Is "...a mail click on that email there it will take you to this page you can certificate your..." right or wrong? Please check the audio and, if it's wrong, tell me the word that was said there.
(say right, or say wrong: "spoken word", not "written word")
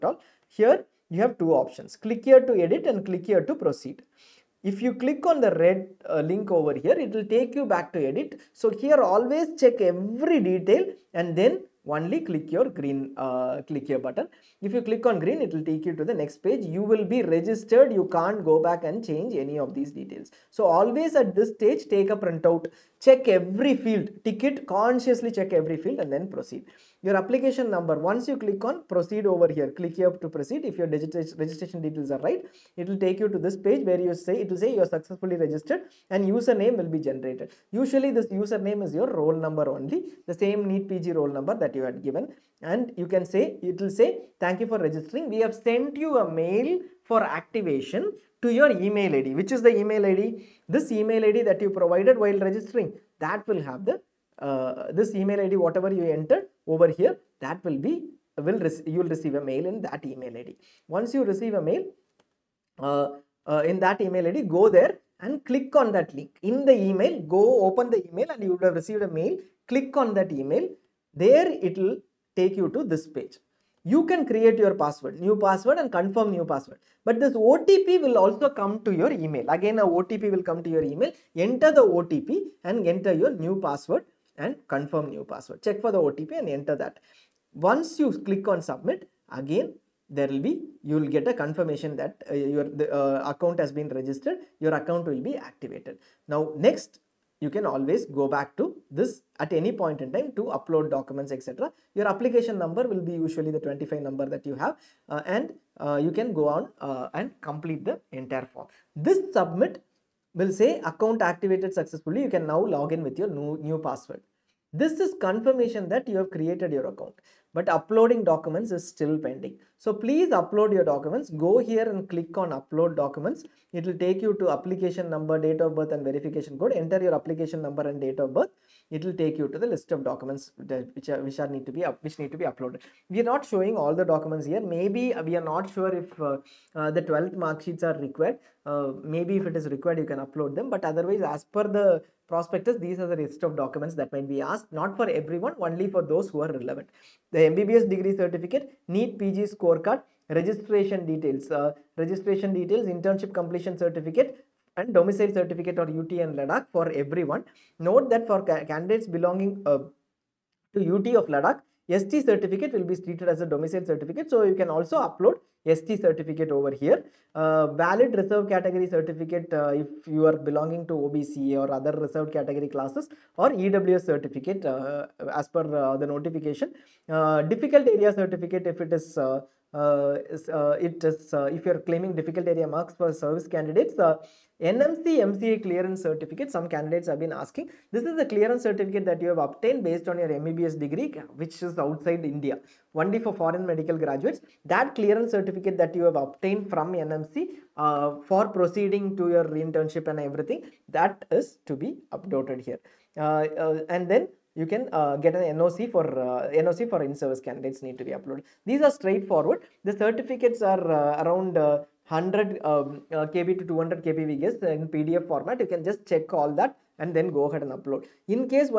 wrong: "create", not "certificate".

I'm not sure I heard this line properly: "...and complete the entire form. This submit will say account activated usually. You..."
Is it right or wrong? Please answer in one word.
wrong.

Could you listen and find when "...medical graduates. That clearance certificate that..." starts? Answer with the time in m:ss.
3:13.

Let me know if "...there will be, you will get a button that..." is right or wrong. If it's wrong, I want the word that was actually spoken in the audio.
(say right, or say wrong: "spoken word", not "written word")
wrong: "confirmation", not "button".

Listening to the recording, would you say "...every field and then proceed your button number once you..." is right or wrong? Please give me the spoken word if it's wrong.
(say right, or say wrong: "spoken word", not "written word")
wrong: "application", not "button".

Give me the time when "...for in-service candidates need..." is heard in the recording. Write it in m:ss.
3:26.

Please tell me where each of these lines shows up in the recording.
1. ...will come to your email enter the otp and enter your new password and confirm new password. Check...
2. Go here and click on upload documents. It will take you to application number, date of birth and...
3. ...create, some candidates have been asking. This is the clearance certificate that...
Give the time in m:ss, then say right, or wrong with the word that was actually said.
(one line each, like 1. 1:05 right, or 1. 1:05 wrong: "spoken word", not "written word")
1. 1:20 right
2. 2:01 right
3. 3:06 wrong: "certificate", not "create".